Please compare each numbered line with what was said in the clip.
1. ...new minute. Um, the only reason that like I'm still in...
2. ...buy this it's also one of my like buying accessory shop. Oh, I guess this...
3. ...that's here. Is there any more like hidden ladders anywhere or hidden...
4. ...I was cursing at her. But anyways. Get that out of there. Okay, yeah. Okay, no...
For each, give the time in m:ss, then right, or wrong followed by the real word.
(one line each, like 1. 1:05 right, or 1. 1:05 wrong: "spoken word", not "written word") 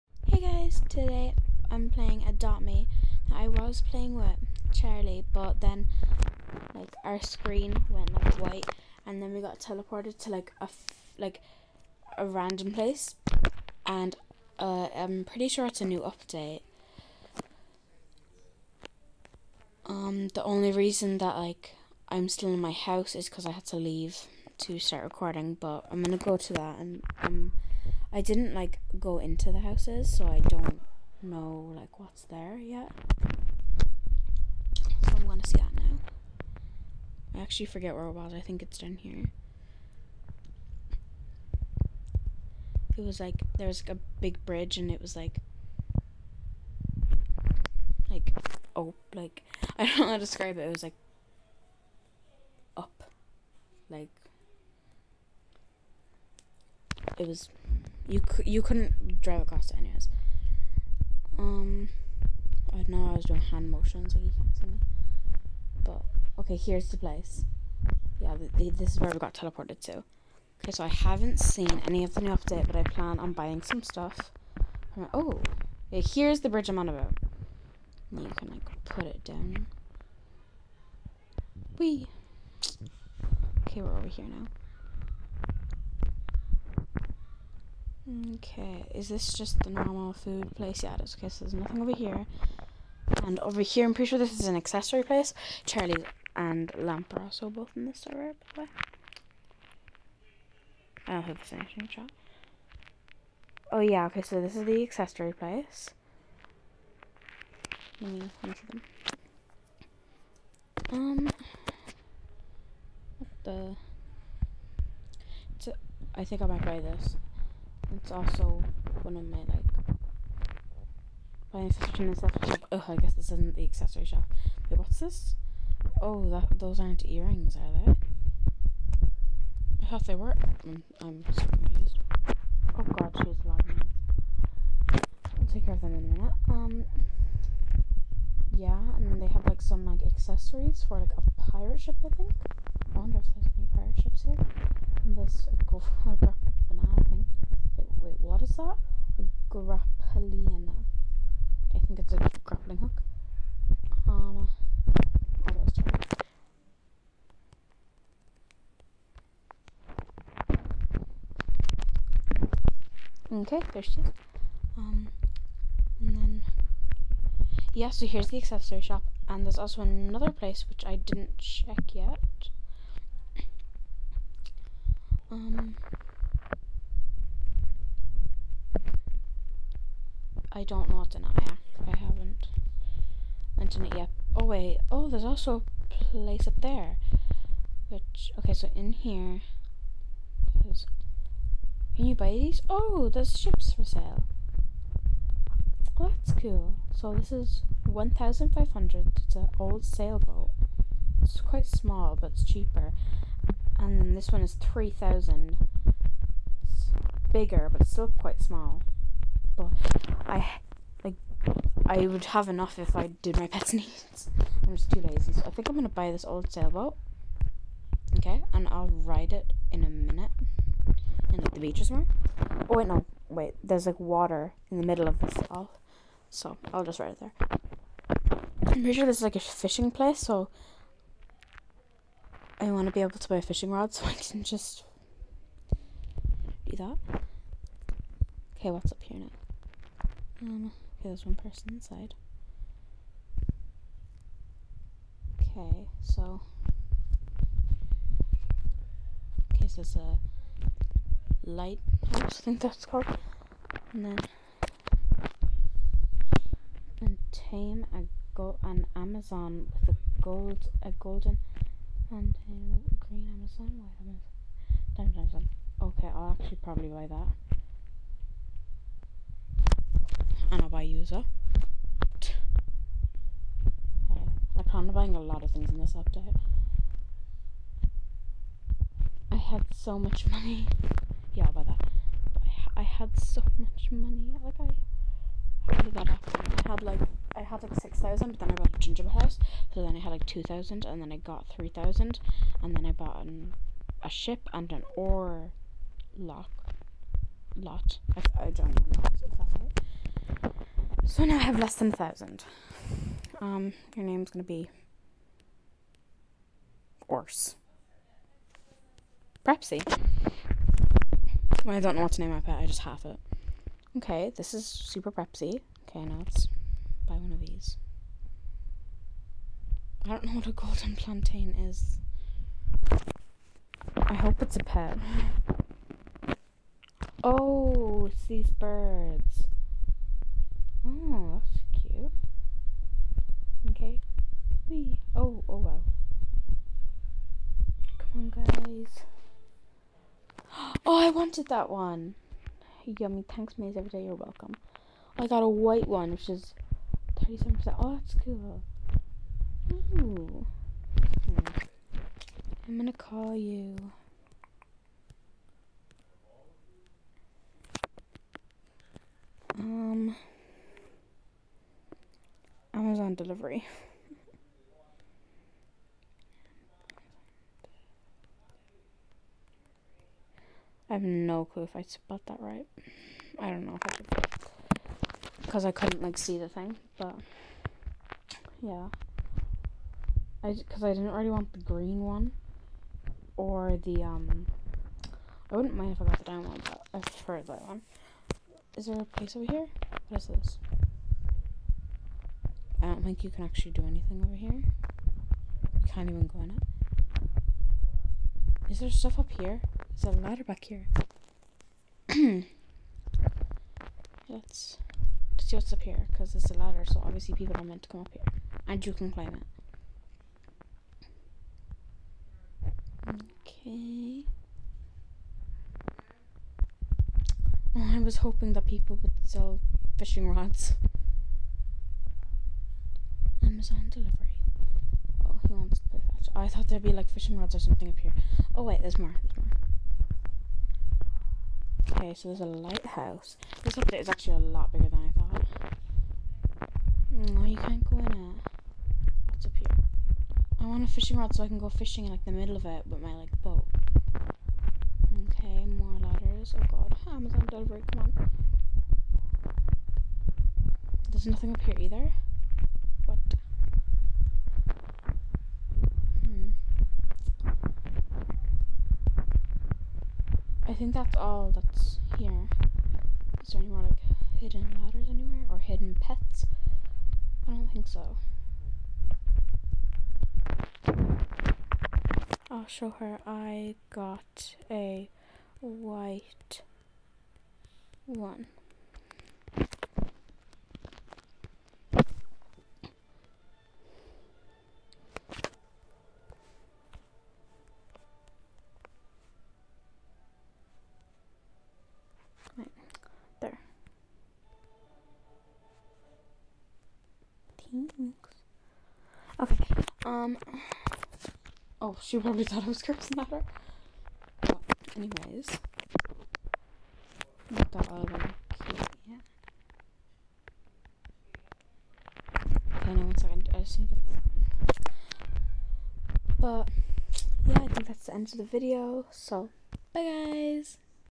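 1. 0:15 wrong: "update", not "minute"
2. 1:56 right
3. 7:41 right
4. 8:22 right.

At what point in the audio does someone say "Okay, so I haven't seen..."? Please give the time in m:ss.
1:10.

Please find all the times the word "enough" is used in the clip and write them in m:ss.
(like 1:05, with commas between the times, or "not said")
3:32.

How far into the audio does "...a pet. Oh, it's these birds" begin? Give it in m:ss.
5:24.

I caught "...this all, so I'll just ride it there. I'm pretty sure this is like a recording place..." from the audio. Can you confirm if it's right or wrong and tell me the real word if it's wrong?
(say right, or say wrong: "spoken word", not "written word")
wrong: "fishing", not "recording".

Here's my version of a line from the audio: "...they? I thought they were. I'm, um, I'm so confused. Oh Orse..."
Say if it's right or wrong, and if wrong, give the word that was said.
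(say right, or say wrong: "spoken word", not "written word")
wrong: "God", not "Orse".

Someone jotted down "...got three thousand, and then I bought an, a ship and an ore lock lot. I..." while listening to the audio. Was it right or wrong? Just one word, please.
right.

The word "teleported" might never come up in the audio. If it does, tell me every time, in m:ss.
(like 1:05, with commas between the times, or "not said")
0:09, 1:09.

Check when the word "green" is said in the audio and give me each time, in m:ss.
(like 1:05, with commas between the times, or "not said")
4:23, 6:21.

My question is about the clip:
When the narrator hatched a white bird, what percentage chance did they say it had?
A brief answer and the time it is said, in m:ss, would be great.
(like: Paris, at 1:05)
37%, at 5:47.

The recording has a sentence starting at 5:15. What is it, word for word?
Okay, now let's buy one of these.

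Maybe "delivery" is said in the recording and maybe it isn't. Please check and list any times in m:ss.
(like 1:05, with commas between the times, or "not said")
6:03, 7:03, 7:27.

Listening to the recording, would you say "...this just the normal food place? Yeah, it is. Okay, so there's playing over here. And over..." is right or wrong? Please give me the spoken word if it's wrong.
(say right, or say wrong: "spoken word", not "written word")
wrong: "nothing", not "playing".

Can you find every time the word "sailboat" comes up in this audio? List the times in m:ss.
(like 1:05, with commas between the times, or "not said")
3:19, 3:36.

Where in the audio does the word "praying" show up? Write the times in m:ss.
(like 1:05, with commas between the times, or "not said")
not said.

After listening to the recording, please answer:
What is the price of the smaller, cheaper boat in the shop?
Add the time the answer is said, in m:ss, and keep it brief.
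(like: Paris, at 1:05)
1,500, at 3:17.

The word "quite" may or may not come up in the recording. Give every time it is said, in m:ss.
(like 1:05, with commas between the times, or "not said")
3:21, 3:28.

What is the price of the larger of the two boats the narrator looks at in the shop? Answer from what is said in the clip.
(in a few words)
3,000.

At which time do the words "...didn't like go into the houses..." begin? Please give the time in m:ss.
0:28.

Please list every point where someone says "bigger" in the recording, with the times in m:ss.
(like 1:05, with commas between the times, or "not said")
3:27, 7:14.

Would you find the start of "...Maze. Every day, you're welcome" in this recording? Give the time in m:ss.
5:43.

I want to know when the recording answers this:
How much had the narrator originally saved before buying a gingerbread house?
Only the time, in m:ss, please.
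4:47.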